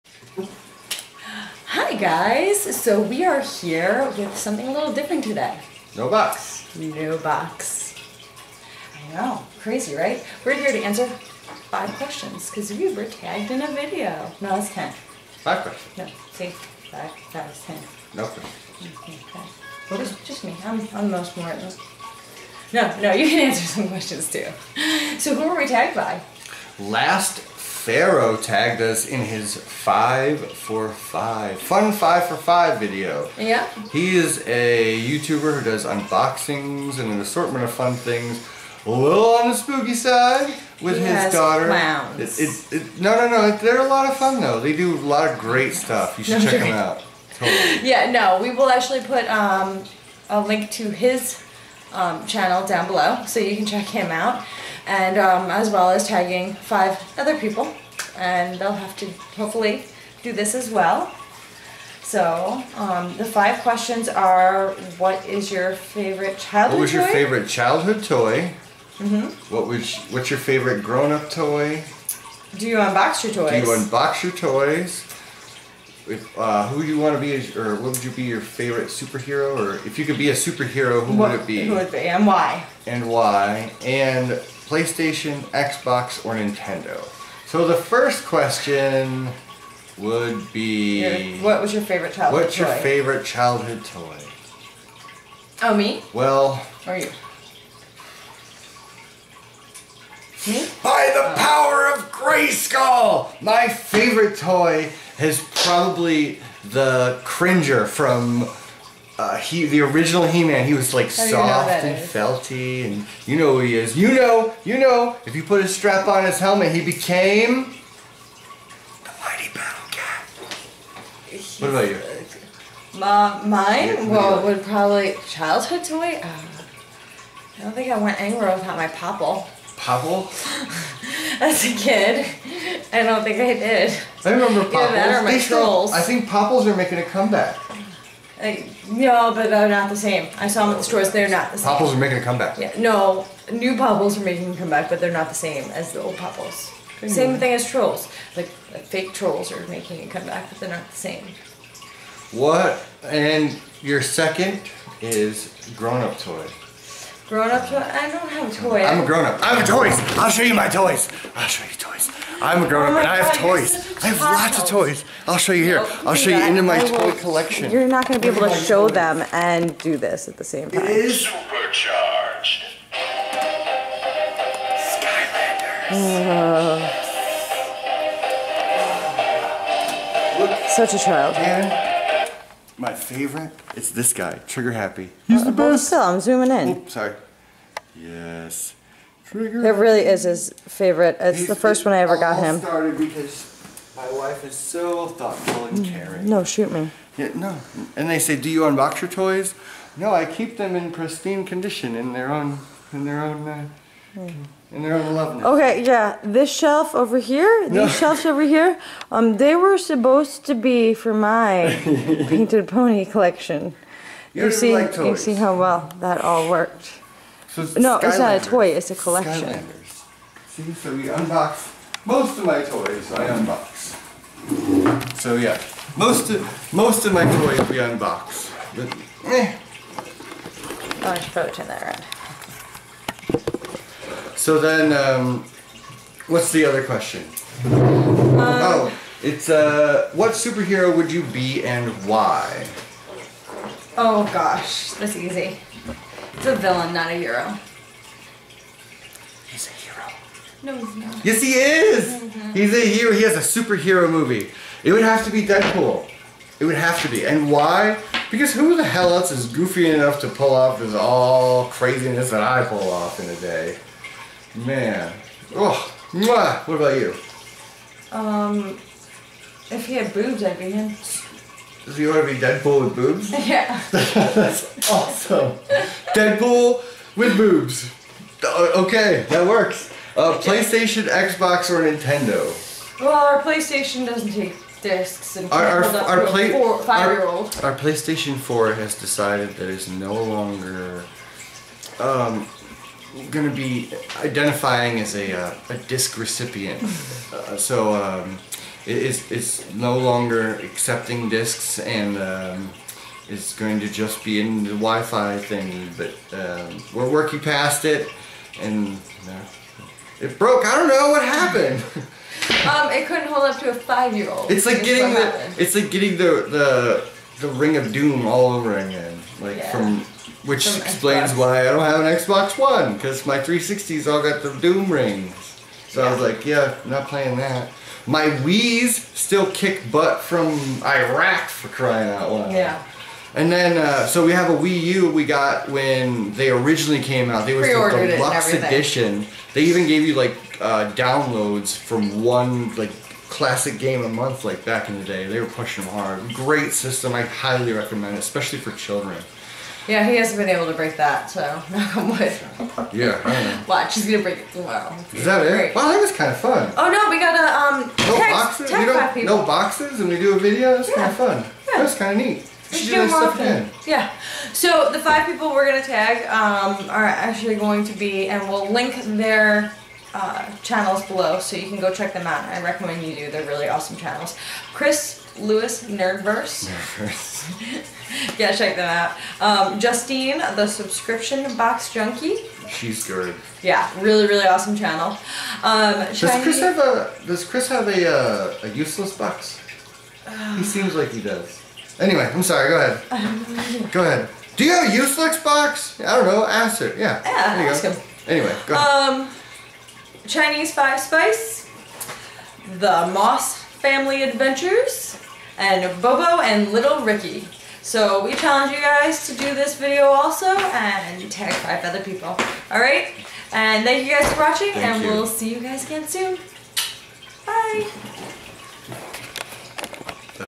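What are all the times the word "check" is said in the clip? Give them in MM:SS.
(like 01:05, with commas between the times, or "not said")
00:46, 00:53, 06:11, 06:18.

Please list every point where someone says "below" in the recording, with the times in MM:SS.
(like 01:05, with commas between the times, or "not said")
00:52, 06:11.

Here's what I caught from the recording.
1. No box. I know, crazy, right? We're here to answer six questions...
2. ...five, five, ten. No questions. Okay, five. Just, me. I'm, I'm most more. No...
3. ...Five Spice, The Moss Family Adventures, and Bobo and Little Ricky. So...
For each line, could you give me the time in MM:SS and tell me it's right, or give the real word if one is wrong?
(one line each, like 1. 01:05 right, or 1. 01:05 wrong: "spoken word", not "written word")
1. 00:06 wrong: "five", not "six"
2. 00:16 right
3. 06:40 right.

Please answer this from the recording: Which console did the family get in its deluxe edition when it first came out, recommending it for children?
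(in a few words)
Wii U.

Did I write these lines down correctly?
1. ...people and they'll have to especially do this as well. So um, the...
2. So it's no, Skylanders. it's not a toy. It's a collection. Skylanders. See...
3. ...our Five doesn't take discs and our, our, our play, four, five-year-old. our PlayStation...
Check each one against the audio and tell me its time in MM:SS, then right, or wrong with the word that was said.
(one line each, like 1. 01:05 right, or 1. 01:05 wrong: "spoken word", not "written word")
1. 00:57 wrong: "hopefully", not "especially"
2. 03:37 right
3. 04:43 wrong: "PlayStation", not "Five".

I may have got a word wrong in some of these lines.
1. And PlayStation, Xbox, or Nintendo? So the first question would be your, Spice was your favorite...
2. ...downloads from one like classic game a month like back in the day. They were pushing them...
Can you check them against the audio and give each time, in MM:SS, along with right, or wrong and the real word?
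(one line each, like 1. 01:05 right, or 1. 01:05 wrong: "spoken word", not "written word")
1. 01:23 wrong: "What", not "Spice"
2. 05:40 right.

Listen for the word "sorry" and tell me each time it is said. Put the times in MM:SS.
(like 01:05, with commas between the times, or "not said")
03:06, 06:32.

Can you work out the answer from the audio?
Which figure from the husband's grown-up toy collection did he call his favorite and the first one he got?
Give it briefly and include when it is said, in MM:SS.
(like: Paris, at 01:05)
Trigger Happy, at 03:04.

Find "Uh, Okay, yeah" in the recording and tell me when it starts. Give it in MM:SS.
03:23.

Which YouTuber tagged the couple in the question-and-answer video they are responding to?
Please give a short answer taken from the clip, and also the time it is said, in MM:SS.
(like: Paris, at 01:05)
Last Pharaoh, at 00:26.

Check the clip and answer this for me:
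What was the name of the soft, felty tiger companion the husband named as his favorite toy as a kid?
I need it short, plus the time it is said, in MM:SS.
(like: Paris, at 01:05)
Cringer, at 01:47.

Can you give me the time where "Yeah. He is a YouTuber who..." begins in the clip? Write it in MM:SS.
00:33.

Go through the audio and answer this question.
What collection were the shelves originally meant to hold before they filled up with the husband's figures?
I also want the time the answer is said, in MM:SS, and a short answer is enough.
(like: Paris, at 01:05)
Painted pony collection, at 03:32.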